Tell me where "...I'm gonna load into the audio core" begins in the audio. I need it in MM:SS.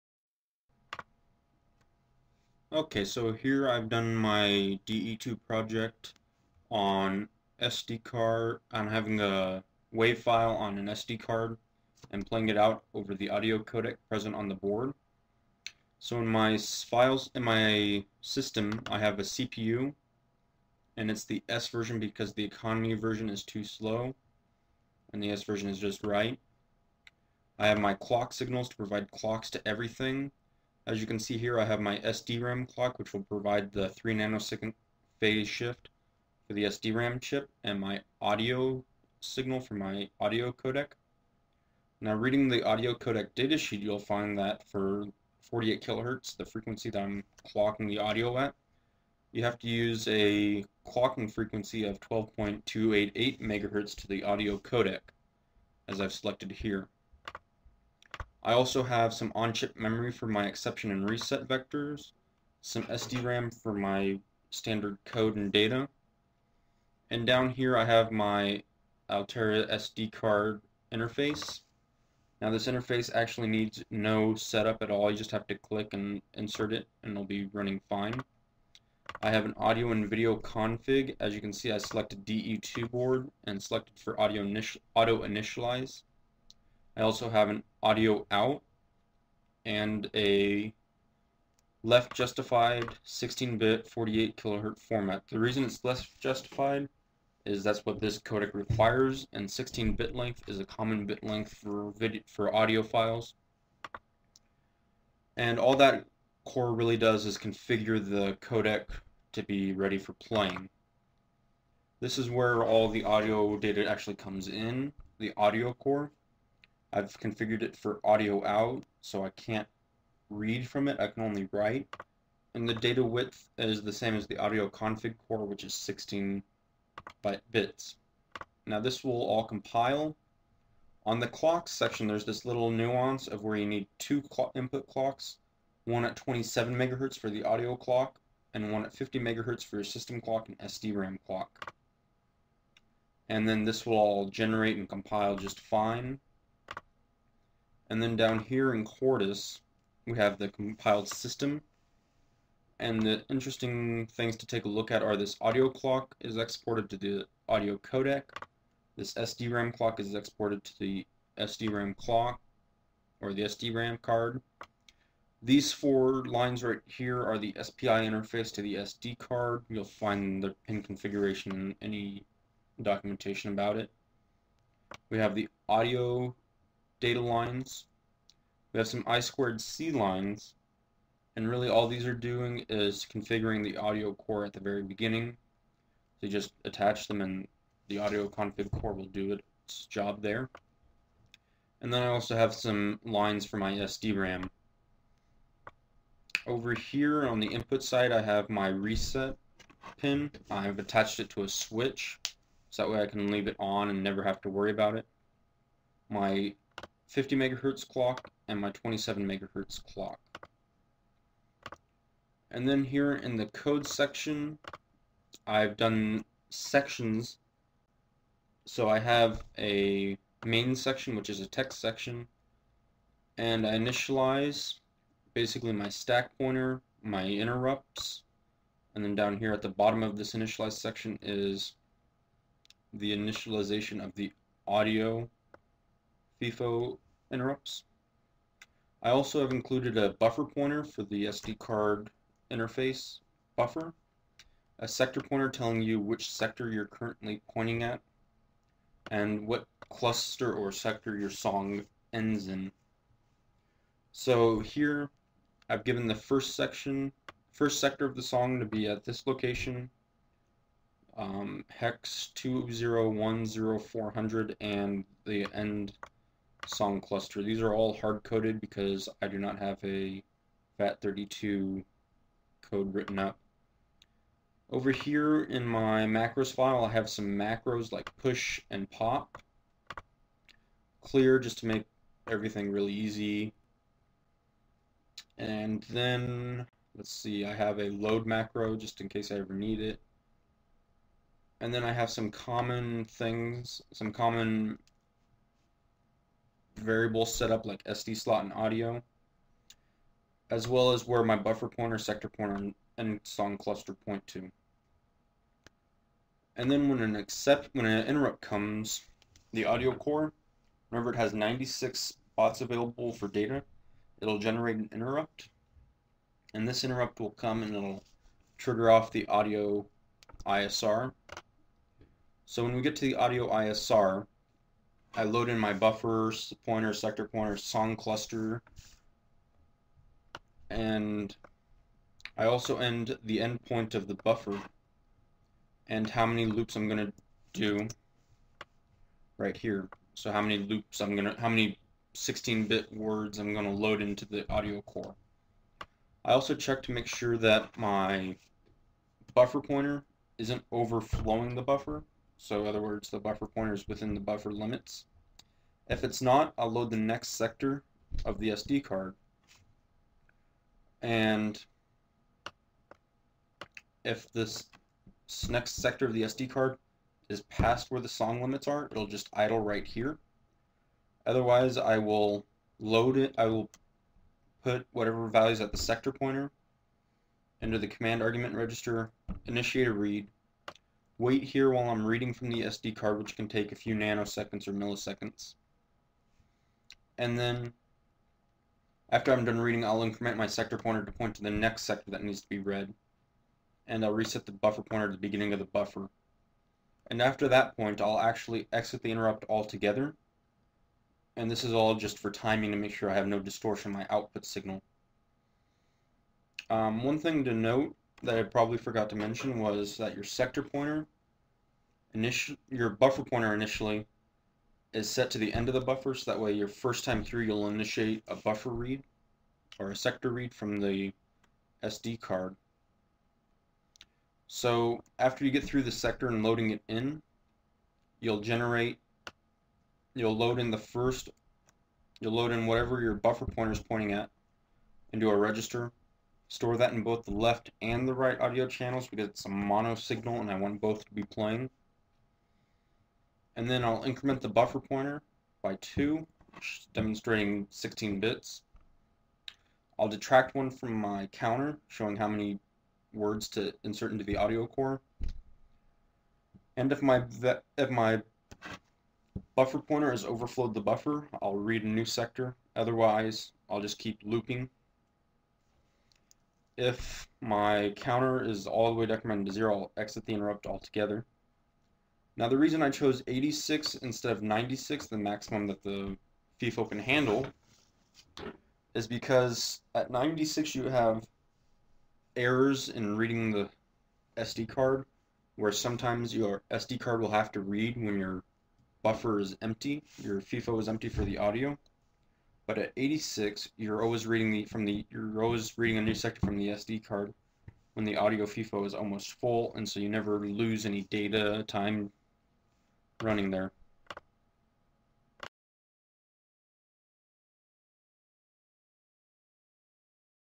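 05:43.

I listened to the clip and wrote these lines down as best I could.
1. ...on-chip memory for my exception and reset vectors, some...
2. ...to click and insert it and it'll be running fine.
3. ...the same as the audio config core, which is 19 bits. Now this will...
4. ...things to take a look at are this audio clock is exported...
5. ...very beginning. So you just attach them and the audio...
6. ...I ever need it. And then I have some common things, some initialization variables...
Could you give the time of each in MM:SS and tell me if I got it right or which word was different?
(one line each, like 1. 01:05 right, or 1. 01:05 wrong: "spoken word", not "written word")
1. 00:59 right
2. 01:15 right
3. 02:03 wrong: "16", not "19"
4. 02:34 right
5. 03:04 right
6. 04:49 wrong: "common", not "initialization".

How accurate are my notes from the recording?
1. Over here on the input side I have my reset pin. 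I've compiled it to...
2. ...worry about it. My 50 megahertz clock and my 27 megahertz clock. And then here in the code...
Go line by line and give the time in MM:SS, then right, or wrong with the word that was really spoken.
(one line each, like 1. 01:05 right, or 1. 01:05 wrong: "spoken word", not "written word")
1. 03:16 wrong: "attached", not "compiled"
2. 03:24 right.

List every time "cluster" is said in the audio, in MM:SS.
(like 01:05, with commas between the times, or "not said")
04:09, 04:27, 05:03, 05:27.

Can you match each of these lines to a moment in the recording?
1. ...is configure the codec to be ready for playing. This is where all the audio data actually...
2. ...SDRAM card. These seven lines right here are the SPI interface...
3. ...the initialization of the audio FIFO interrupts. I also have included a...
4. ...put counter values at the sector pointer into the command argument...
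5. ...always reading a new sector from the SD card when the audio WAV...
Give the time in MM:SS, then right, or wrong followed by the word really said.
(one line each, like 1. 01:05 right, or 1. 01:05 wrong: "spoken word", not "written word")
1. 01:47 right
2. 02:43 wrong: "four", not "seven"
3. 03:52 right
4. 06:14 wrong: "whatever", not "counter"
5. 08:15 wrong: "FIFO", not "WAV".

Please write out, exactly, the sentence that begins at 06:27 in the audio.
And then, after I'm done reading, I'll increment my sector pointer to point to the next sector that needs to be read.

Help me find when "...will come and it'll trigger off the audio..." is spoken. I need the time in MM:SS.
05:17.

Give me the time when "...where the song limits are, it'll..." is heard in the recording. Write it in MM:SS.
06:07.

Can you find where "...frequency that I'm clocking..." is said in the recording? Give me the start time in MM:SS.
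00:46.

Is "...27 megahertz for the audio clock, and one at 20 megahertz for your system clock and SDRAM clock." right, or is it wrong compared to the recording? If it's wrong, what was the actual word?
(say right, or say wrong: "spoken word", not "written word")
wrong: "50", not "20".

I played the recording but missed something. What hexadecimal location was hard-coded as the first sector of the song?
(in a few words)
0x2010400.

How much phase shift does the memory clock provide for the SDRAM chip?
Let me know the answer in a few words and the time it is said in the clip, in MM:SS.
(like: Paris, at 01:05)
3 nanoseconds, at 00:33.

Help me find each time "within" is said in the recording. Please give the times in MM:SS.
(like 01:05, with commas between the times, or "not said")
05:53.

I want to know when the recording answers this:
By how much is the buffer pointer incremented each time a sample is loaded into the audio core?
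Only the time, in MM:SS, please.
07:25.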